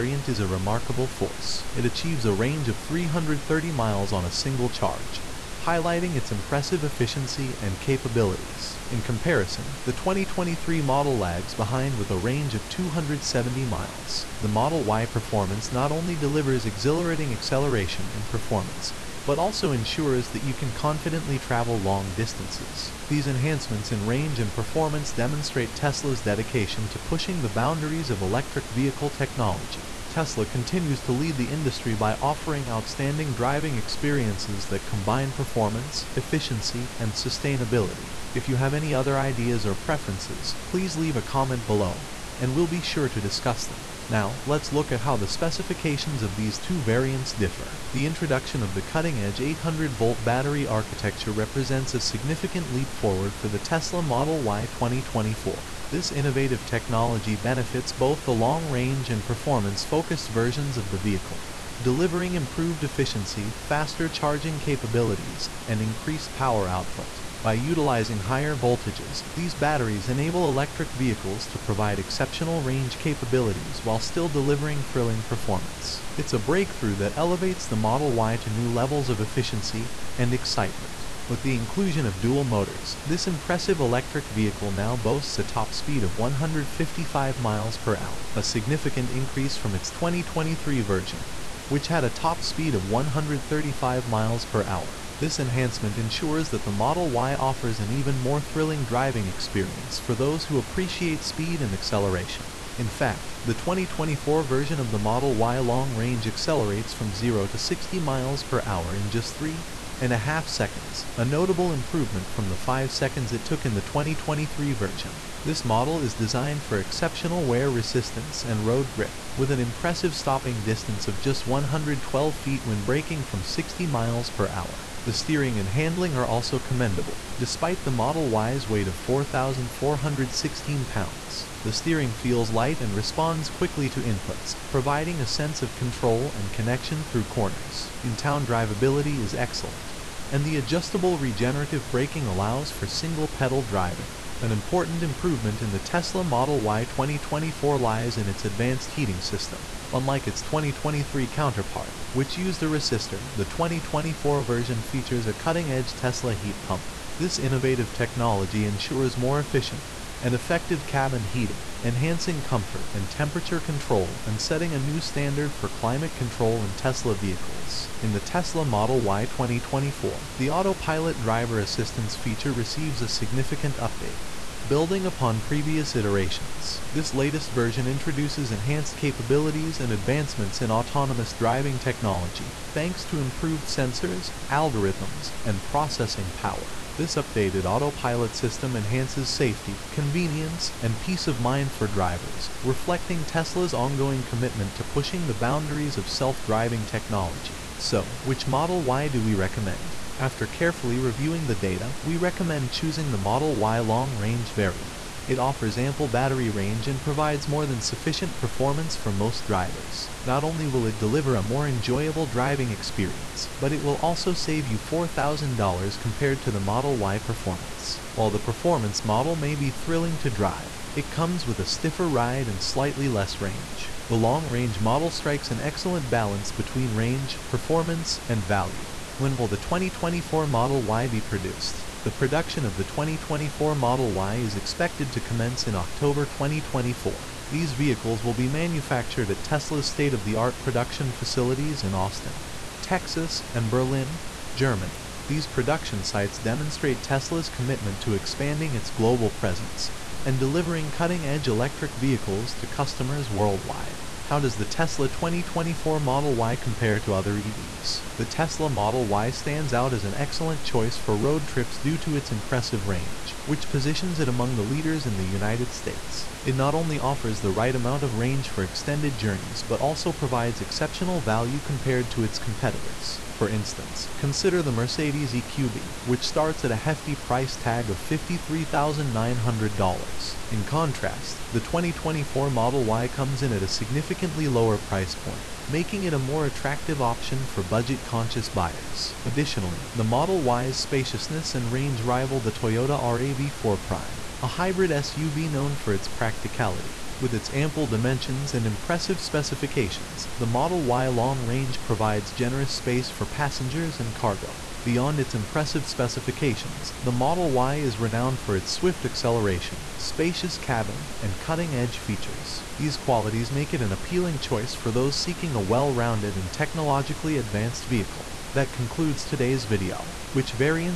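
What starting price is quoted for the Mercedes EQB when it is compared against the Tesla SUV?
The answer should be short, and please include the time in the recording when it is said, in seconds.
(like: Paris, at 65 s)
$53,900, at 278 s.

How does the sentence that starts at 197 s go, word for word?
So, which Model Y do we recommend?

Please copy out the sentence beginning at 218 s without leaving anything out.
While the performance model may be thrilling to drive, it comes with a stiffer ride and slightly less range.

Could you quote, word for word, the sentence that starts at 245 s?
These production sites demonstrate Tesla's commitment to expanding its global presence and delivering cutting-edge electric vehicles to customers worldwide.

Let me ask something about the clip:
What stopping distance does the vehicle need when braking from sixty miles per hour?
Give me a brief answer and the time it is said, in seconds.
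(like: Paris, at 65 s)
112 feet, at 121 s.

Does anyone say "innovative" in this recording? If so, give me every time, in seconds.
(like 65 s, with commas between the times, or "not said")
56 s, 157 s.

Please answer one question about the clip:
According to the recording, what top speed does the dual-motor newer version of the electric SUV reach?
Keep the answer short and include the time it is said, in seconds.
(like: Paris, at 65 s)
155 miles per hour, at 86 s.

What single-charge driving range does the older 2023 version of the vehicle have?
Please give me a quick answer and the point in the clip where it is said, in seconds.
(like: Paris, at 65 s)
270 miles, at 12 s.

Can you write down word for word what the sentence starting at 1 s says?
It achieves a range of 330 miles on a single charge, highlighting its impressive efficiency and capabilities.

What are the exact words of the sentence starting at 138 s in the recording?
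In-town drivability is excellent, and the adjustable regenerative braking allows for single-pedal driving.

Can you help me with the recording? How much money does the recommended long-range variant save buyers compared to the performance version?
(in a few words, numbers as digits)
$4,000.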